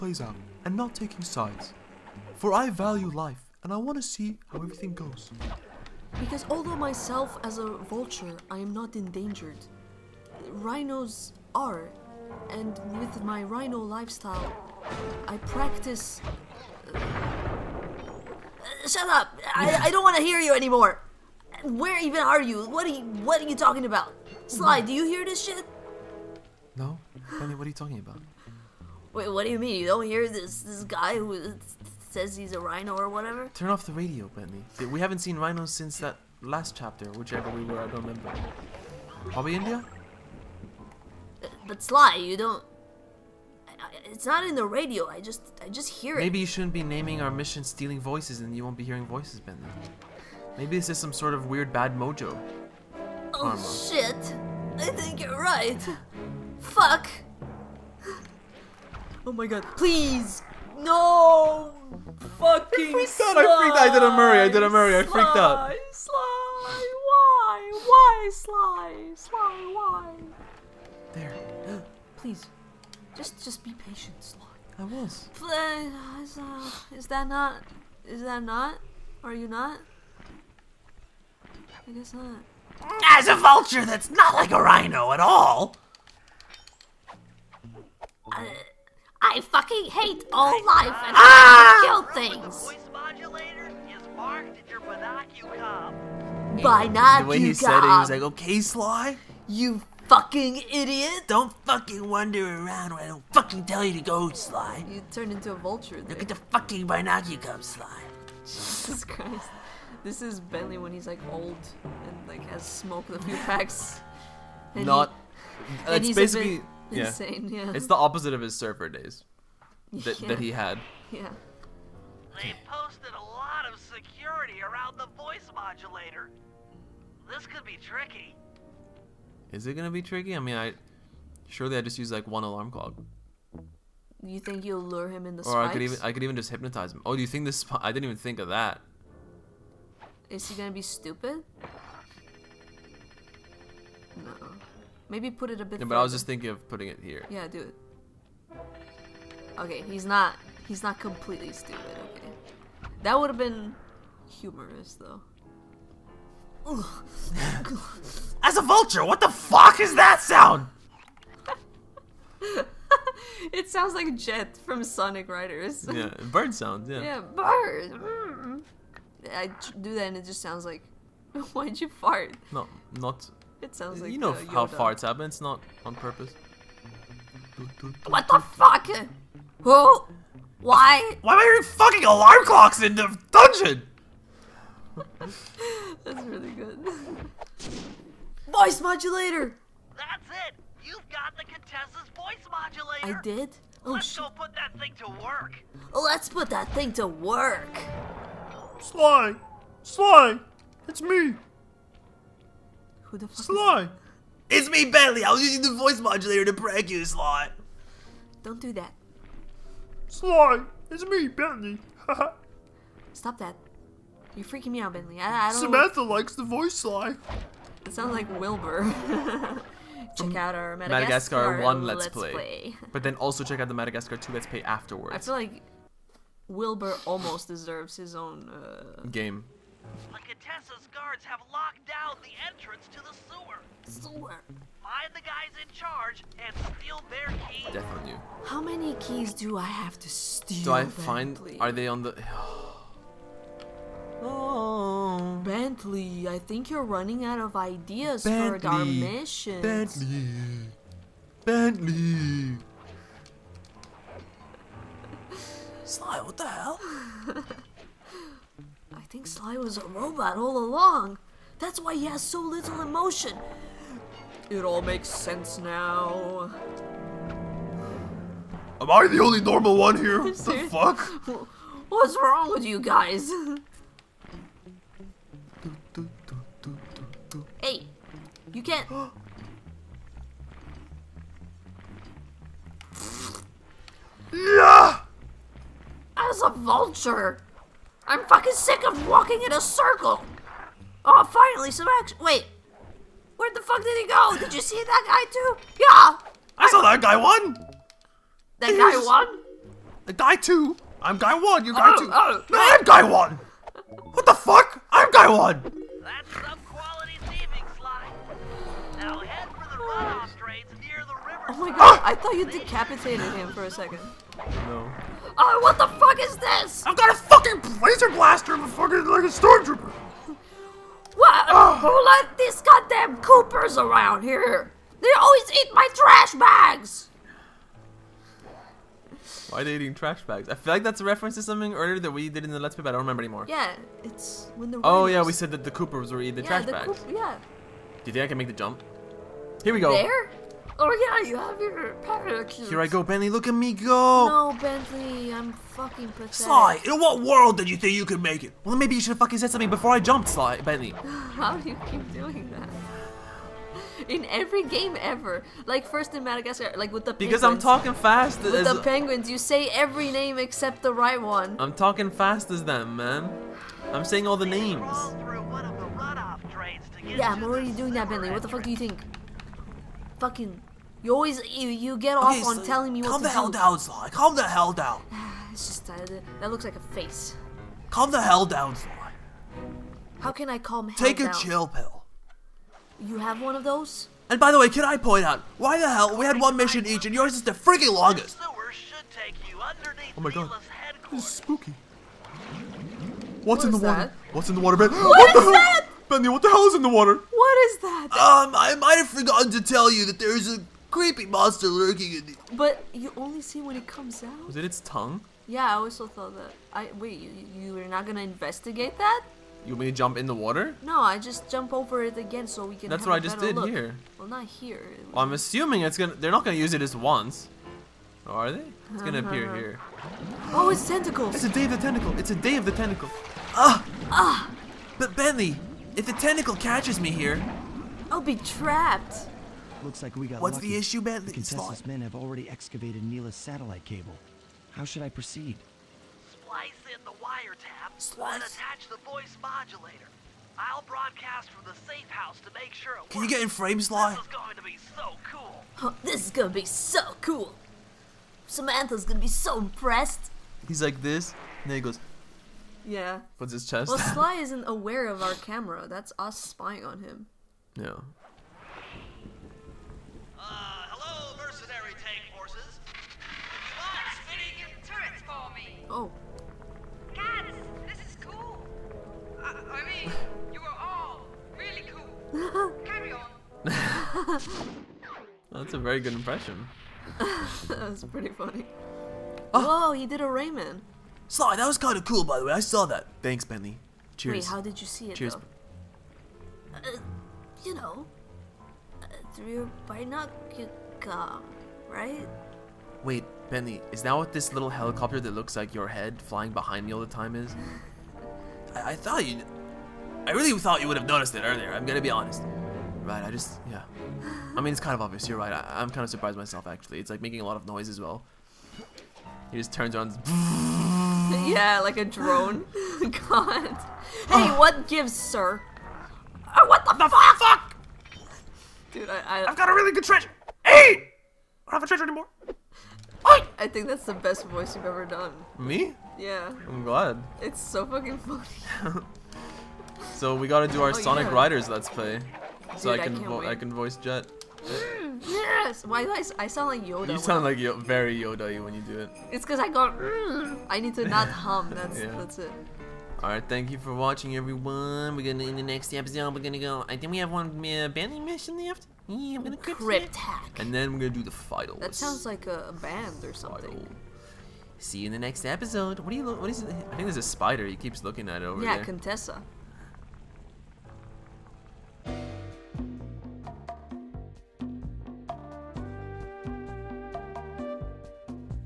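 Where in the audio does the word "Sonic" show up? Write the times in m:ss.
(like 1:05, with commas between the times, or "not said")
2:44, 8:50.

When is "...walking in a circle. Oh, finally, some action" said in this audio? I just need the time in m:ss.
4:49.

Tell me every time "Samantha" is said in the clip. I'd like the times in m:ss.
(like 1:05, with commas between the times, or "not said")
3:35, 7:28.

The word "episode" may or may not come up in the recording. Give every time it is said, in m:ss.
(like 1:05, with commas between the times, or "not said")
9:05, 9:15.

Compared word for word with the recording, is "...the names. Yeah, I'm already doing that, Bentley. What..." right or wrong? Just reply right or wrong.
right.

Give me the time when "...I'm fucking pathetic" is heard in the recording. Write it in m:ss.
5:45.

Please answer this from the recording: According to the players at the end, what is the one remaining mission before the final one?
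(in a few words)
crypt hack.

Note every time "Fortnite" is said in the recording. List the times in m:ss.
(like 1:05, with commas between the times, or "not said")
not said.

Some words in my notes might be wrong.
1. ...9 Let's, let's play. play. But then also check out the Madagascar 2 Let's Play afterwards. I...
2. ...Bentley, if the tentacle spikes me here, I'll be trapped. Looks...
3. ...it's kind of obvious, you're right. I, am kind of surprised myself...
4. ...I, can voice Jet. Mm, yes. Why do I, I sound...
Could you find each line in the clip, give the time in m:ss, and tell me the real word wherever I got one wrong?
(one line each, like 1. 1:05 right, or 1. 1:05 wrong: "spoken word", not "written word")
1. 3:41 wrong: "1", not "9"
2. 7:05 wrong: "catches", not "spikes"
3. 8:24 right
4. 8:53 right.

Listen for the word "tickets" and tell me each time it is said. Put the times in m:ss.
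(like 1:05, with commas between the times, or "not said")
not said.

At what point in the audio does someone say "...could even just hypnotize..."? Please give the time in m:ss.
2:16.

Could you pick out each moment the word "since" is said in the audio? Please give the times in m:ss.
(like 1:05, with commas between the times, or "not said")
0:35.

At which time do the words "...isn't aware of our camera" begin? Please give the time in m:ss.
7:34.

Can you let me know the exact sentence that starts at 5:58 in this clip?
With the penguins, you say every name except the right one.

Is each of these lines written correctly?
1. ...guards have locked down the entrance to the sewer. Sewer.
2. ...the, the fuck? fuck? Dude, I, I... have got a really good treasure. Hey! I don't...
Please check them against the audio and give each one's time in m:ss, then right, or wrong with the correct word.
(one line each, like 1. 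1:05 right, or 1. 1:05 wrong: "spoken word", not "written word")
1. 3:50 right
2. 8:36 right.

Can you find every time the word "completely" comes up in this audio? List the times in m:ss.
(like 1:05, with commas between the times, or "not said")
2:31.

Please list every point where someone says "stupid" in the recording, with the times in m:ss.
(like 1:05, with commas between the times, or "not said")
2:20, 2:31.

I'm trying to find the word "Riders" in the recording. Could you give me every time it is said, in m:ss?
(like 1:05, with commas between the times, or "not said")
2:45, 8:51.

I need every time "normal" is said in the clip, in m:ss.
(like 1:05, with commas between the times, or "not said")
4:29.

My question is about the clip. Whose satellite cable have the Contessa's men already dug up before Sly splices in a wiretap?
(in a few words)
Neyla's.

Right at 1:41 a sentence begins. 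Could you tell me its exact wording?
Don't fucking wander around when I don't fucking tell you to go, Sly.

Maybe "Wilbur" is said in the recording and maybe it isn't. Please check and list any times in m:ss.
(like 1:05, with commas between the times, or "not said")
3:38, 3:46.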